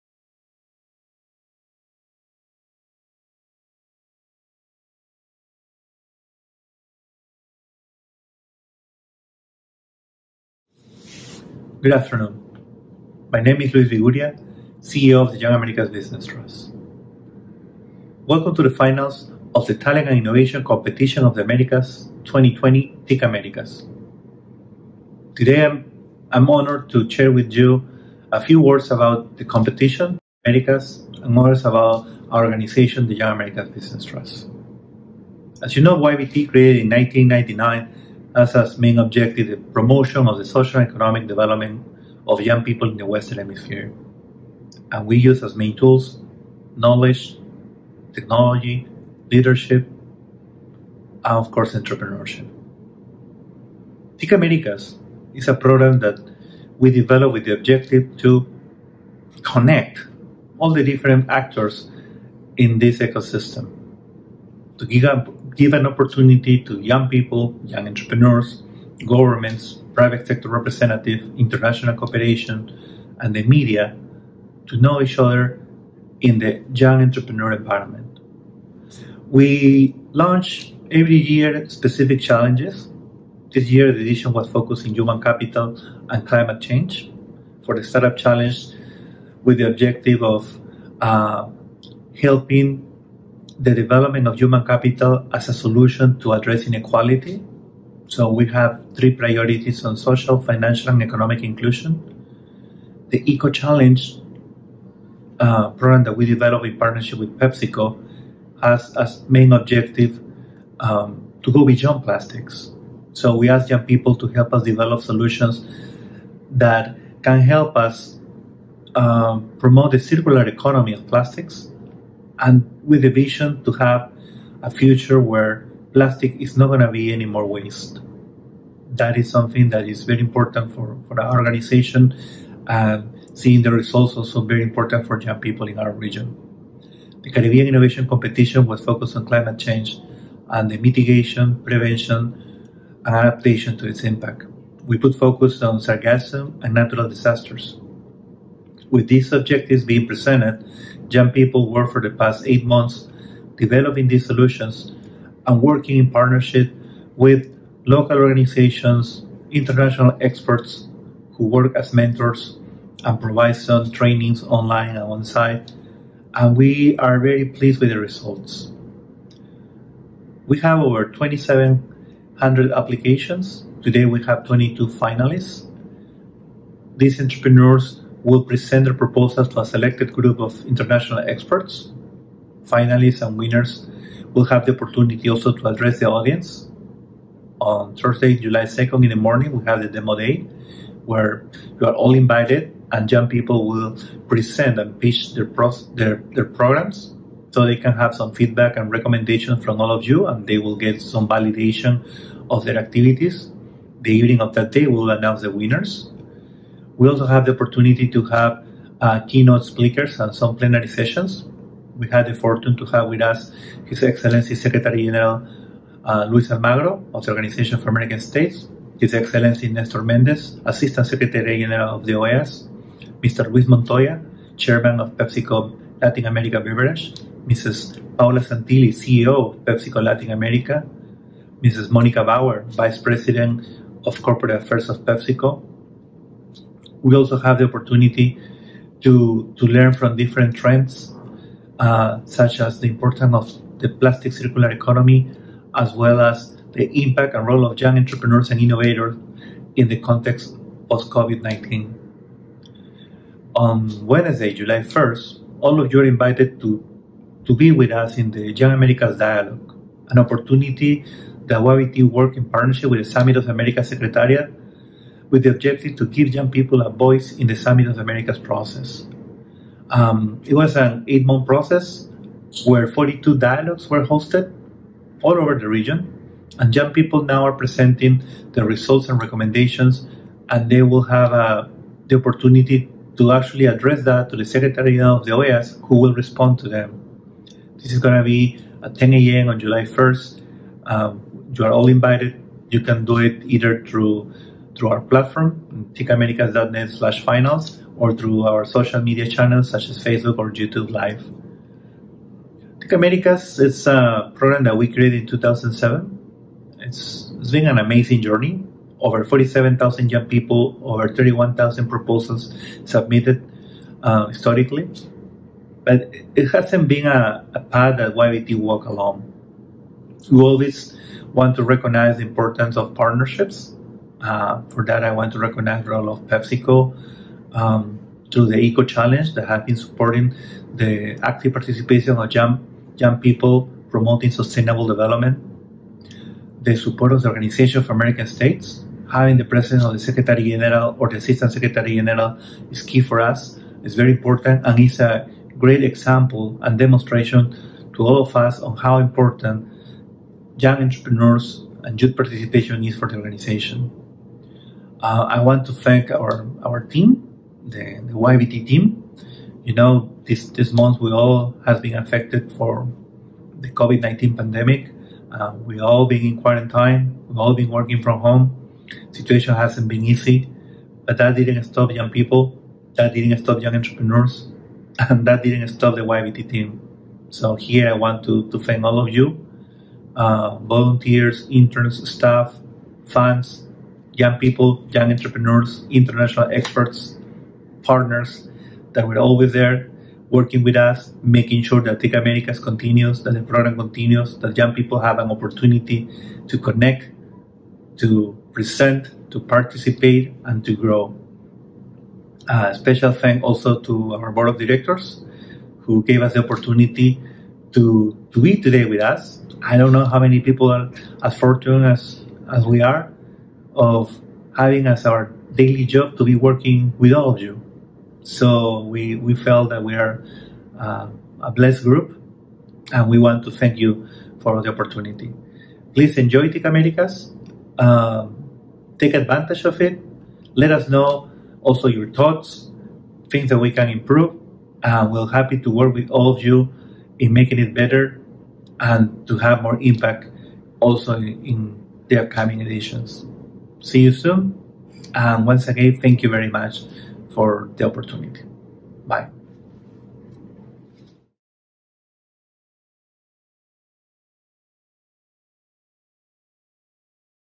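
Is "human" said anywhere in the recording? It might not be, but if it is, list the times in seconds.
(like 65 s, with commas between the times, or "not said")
84 s, 94 s.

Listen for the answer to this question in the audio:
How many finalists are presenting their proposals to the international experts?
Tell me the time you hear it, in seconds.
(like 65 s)
174 s.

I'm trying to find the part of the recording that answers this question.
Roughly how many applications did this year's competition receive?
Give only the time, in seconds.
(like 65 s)
170 s.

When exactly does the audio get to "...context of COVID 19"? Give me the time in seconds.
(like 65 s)
249 s.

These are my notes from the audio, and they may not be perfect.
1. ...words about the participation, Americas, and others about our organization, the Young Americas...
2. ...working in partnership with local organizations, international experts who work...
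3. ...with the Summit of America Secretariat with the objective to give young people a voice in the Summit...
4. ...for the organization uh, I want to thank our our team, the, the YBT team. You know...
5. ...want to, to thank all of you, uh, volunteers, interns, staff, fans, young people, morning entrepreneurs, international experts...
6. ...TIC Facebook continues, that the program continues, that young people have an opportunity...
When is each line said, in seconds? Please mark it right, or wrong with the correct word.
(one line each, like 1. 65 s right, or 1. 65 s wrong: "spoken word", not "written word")
1. 28 s wrong: "competition", not "participation"
2. 155 s right
3. 262 s right
4. 352 s right
5. 377 s wrong: "young", not "morning"
6. 391 s wrong: "Americas", not "Facebook".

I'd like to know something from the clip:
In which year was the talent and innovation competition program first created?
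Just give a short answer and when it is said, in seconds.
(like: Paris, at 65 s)
2007, at 305 s.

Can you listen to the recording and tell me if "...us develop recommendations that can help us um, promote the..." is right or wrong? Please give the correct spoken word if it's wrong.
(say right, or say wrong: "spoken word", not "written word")
wrong: "solutions", not "recommendations".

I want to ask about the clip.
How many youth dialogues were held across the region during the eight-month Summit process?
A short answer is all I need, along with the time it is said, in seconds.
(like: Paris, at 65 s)
42, at 272 s.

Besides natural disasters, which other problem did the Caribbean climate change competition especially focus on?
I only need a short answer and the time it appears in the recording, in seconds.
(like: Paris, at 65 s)
Sargassum, at 145 s.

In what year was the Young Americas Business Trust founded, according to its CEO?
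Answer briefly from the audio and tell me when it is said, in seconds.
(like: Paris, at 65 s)
1999, at 36 s.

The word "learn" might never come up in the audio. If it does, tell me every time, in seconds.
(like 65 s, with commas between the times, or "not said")
239 s.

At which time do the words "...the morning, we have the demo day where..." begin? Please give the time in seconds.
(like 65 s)
189 s.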